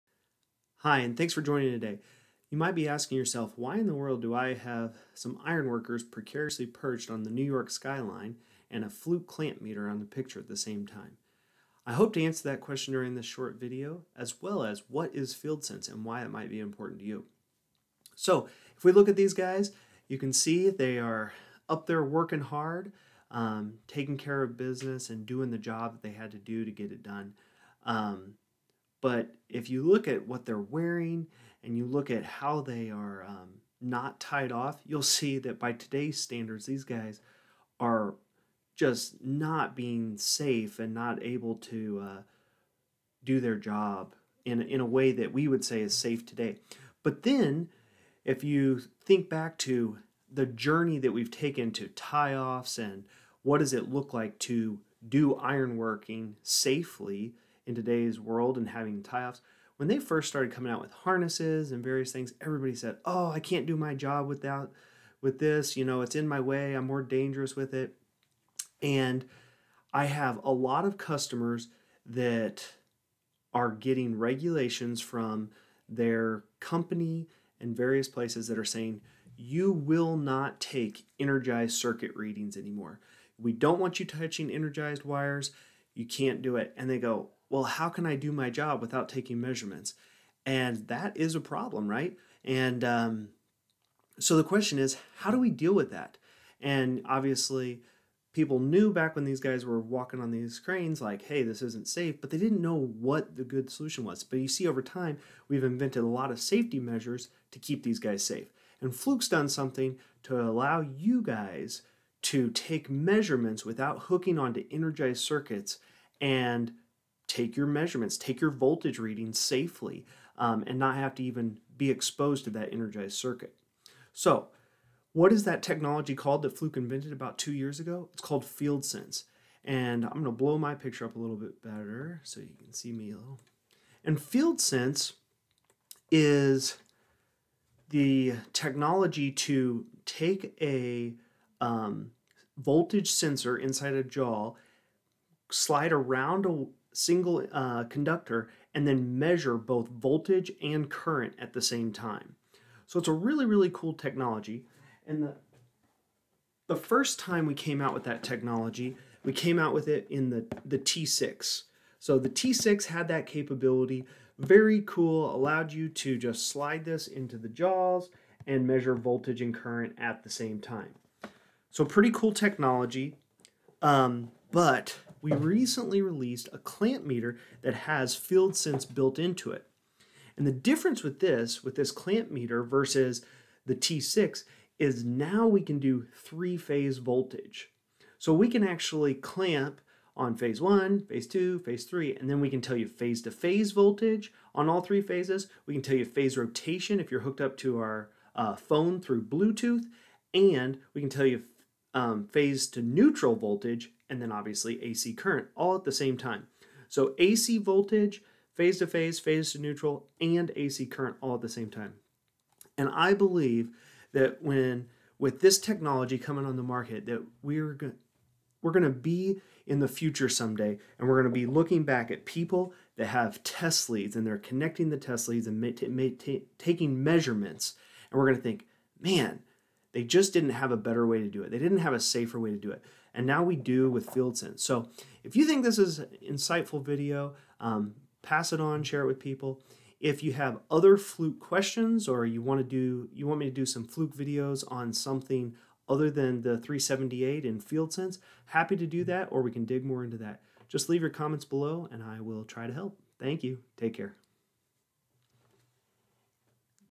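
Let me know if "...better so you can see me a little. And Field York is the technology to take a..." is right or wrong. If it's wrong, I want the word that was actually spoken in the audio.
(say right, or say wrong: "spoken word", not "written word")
wrong: "Sense", not "York".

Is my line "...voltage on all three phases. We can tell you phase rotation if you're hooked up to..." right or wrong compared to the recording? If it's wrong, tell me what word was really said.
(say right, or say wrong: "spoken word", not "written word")
right.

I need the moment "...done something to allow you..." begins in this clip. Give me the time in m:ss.
1:49.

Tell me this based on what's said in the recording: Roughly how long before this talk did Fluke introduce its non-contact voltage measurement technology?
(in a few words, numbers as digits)
about two years ago.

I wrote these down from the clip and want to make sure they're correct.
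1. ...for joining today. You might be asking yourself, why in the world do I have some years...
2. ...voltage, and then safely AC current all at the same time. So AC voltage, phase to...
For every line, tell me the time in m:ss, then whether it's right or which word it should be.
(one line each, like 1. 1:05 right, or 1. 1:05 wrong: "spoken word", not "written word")
1. 0:01 wrong: "ironworkers", not "years"
2. 3:23 wrong: "obviously", not "safely".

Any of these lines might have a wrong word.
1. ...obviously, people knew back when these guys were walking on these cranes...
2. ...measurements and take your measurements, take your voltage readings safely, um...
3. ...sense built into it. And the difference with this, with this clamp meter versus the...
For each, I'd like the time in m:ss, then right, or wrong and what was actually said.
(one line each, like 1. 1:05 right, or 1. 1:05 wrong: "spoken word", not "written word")
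1. 1:37 right
2. 1:55 wrong: "circuits", not "measurements"
3. 2:58 right.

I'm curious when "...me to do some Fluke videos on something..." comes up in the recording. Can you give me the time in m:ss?
4:03.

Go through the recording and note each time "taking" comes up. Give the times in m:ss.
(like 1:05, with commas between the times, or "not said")
0:23, 1:29, 3:46.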